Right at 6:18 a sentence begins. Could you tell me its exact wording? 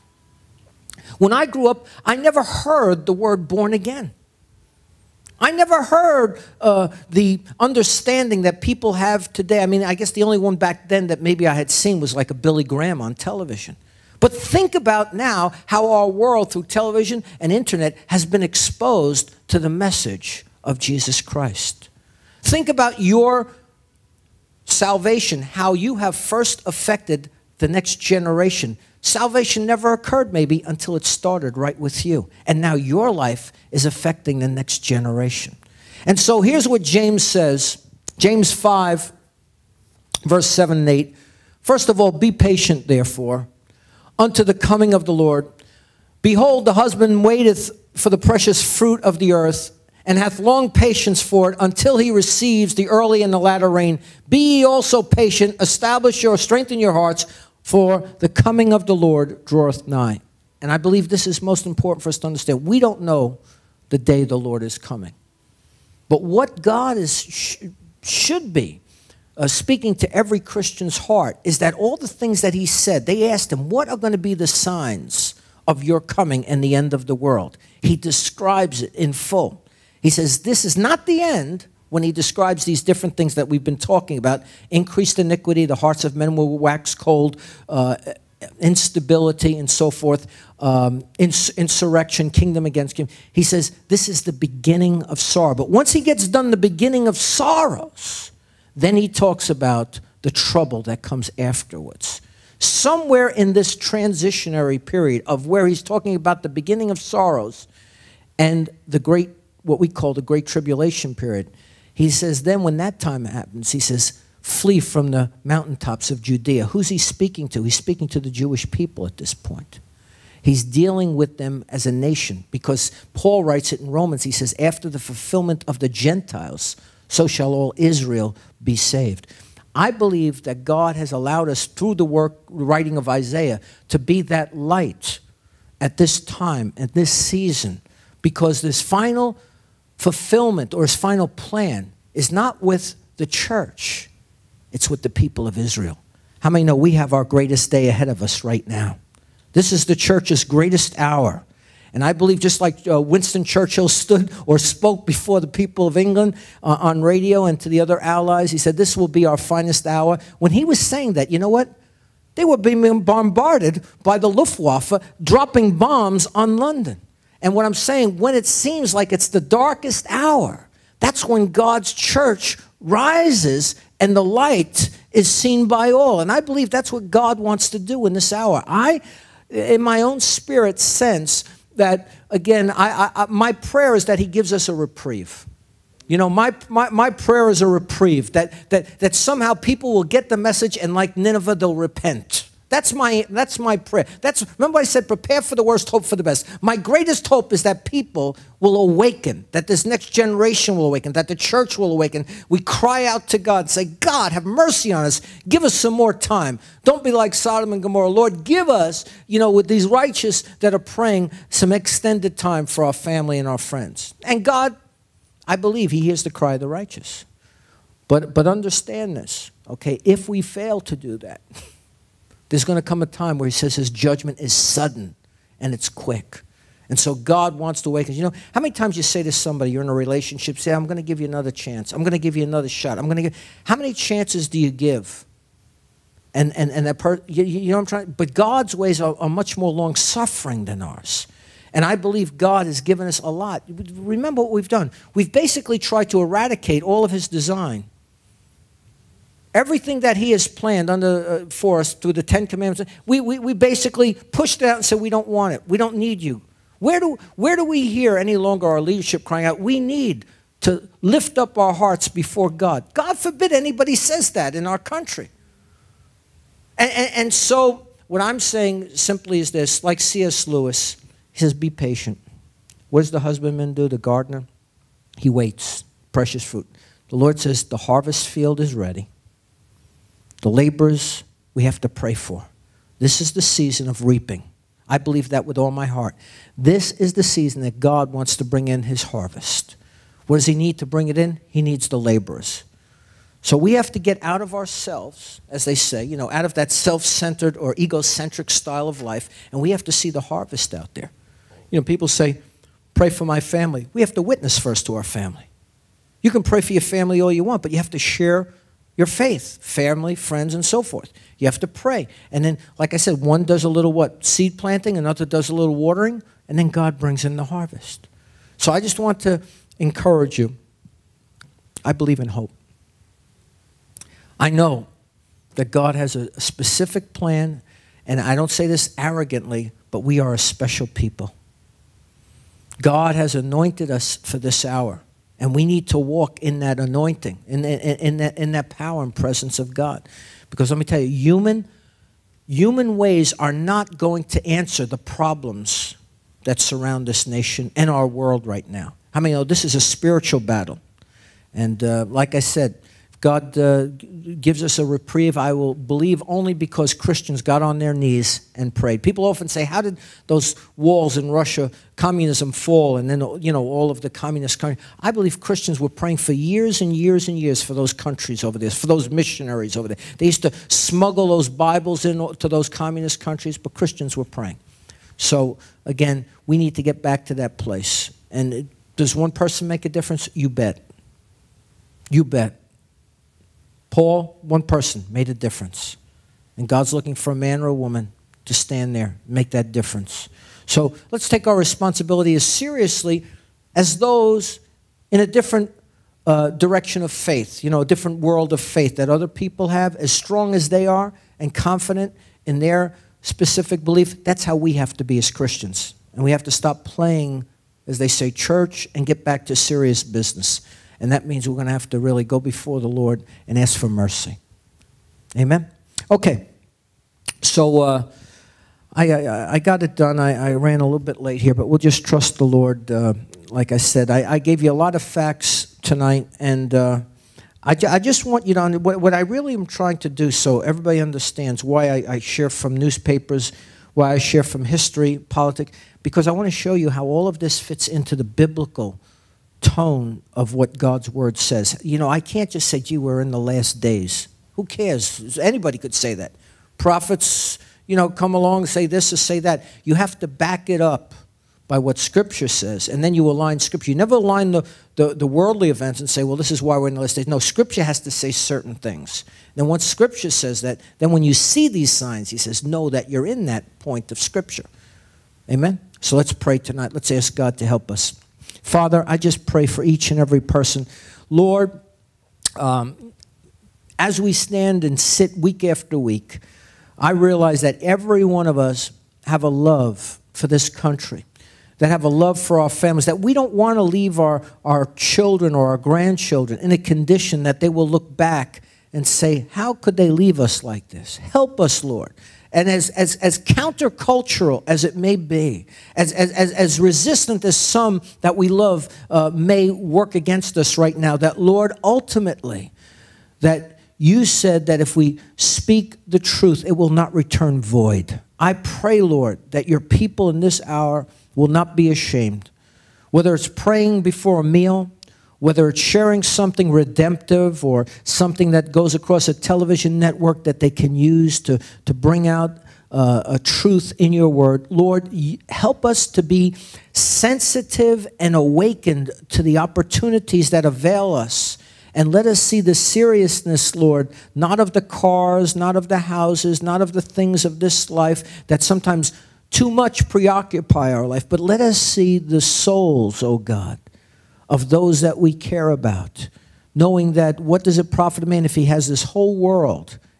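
And uh, does one person make a difference?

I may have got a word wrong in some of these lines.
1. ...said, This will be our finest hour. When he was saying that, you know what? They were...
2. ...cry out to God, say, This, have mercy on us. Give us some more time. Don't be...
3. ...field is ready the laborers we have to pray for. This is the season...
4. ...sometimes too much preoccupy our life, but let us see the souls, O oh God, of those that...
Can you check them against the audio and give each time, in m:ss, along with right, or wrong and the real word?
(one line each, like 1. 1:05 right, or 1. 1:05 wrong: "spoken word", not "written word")
1. 2:38 right
2. 3:22 wrong: "God", not "This"
3. 4:38 right
4. 8:58 right.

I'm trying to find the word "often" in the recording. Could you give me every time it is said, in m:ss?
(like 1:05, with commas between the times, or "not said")
5:59.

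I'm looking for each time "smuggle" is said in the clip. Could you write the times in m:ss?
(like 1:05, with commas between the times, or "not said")
6:10.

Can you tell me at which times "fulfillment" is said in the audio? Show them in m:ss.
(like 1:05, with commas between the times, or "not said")
2:04, 2:19.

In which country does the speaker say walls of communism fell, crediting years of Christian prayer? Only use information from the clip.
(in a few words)
Russia.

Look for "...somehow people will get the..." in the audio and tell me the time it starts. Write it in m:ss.
3:09.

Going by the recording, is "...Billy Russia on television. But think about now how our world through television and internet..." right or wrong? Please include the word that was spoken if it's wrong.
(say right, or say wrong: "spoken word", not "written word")
wrong: "Graham", not "Russia".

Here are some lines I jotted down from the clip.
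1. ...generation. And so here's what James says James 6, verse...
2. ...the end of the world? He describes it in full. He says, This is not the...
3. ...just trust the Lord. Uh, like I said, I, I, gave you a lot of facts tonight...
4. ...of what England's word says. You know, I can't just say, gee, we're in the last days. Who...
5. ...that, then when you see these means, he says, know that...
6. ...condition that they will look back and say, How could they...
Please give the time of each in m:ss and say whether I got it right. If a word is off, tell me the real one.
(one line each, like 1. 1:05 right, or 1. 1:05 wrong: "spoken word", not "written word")
1. 0:34 wrong: "5", not "6"
2. 1:16 right
3. 7:01 right
4. 7:20 wrong: "God", not "England"
5. 7:40 wrong: "signs", not "means"
6. 8:06 right.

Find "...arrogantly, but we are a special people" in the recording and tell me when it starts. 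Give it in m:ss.
5:28.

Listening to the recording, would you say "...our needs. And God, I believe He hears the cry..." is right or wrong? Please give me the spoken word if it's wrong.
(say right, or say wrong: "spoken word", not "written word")
wrong: "friends", not "needs".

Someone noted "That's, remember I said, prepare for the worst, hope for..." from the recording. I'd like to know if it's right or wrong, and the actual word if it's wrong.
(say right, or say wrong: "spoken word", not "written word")
right.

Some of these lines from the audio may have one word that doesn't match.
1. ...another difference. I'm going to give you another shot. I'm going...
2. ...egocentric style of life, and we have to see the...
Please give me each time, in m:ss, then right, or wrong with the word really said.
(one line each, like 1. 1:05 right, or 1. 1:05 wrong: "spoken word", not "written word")
1. 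3:51 wrong: "chance", not "difference"
2. 4:57 right.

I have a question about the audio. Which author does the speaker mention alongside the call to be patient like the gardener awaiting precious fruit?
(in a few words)
C.S. Lewis.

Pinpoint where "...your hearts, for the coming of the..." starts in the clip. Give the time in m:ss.
0:56.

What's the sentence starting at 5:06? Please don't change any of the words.
You can pray for your family all you want, but you have to share your faith, family, friends, and so forth.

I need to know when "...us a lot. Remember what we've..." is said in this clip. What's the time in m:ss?
4:03.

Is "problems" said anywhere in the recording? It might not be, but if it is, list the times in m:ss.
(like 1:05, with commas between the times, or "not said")
5:44.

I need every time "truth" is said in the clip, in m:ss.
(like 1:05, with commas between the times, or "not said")
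8:26, 8:43.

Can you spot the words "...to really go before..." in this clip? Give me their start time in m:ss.
6:51.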